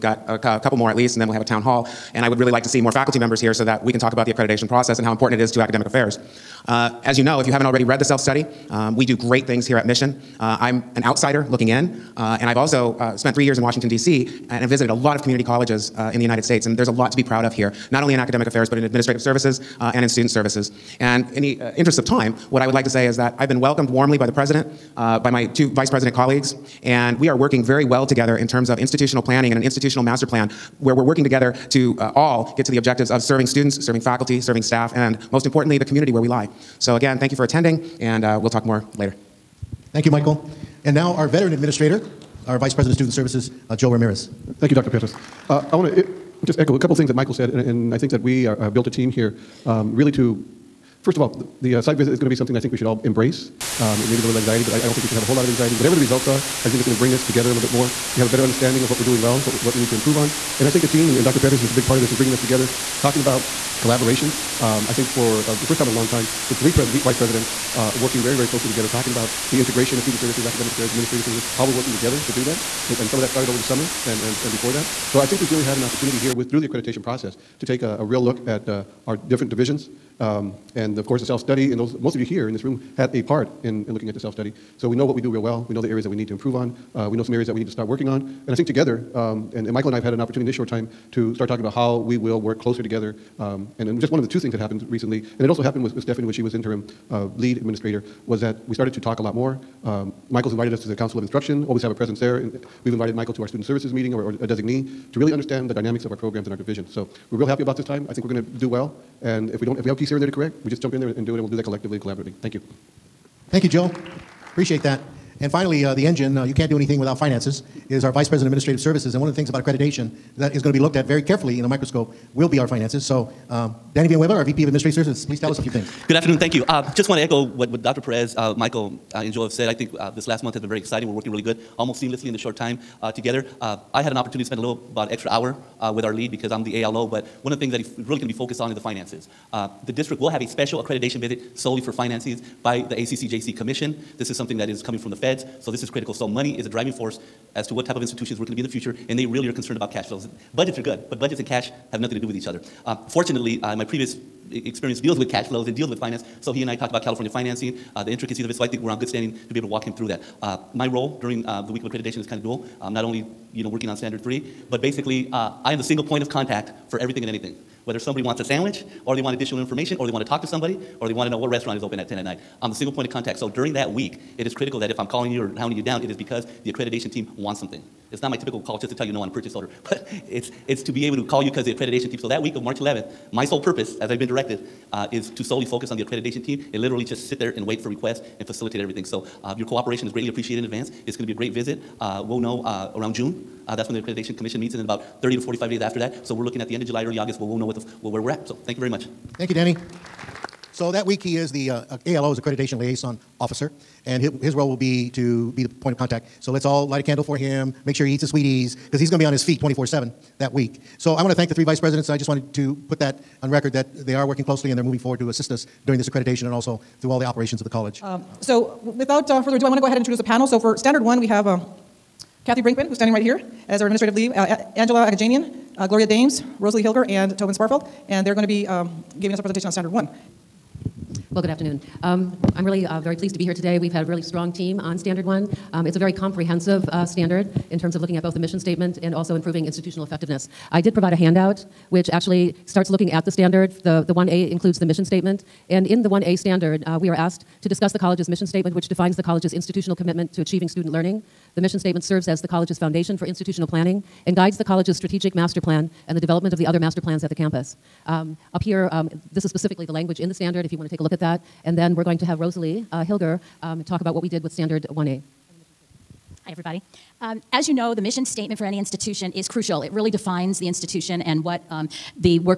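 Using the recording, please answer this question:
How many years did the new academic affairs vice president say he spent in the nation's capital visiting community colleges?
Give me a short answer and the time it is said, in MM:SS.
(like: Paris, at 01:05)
3, at 00:13.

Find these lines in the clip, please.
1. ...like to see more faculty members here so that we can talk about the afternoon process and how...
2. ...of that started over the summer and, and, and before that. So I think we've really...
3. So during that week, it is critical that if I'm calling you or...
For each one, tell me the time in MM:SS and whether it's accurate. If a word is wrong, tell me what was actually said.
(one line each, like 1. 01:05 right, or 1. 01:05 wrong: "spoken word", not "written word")
1. 00:02 wrong: "accreditation", not "afternoon"
2. 01:13 right
3. 02:53 right.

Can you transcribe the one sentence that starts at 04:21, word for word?
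And then we're going to have Rosalie uh, Hilger um, talk about what we did with Standard 1A.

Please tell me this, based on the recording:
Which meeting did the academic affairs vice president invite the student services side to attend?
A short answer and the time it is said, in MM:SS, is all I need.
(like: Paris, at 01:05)
Council of Instruction, at 01:40.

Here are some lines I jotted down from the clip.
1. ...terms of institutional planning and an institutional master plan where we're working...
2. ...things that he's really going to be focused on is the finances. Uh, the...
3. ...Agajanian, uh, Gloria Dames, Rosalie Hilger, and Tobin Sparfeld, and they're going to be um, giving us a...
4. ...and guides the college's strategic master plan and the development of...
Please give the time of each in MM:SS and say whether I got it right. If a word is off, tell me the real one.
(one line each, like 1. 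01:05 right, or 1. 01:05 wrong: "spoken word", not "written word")
1. 00:28 right
2. 02:17 right
3. 03:45 right
4. 04:14 right.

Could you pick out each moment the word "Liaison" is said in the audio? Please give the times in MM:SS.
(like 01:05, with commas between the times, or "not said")
03:22.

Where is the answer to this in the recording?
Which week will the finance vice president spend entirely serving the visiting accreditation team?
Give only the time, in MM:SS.
03:02.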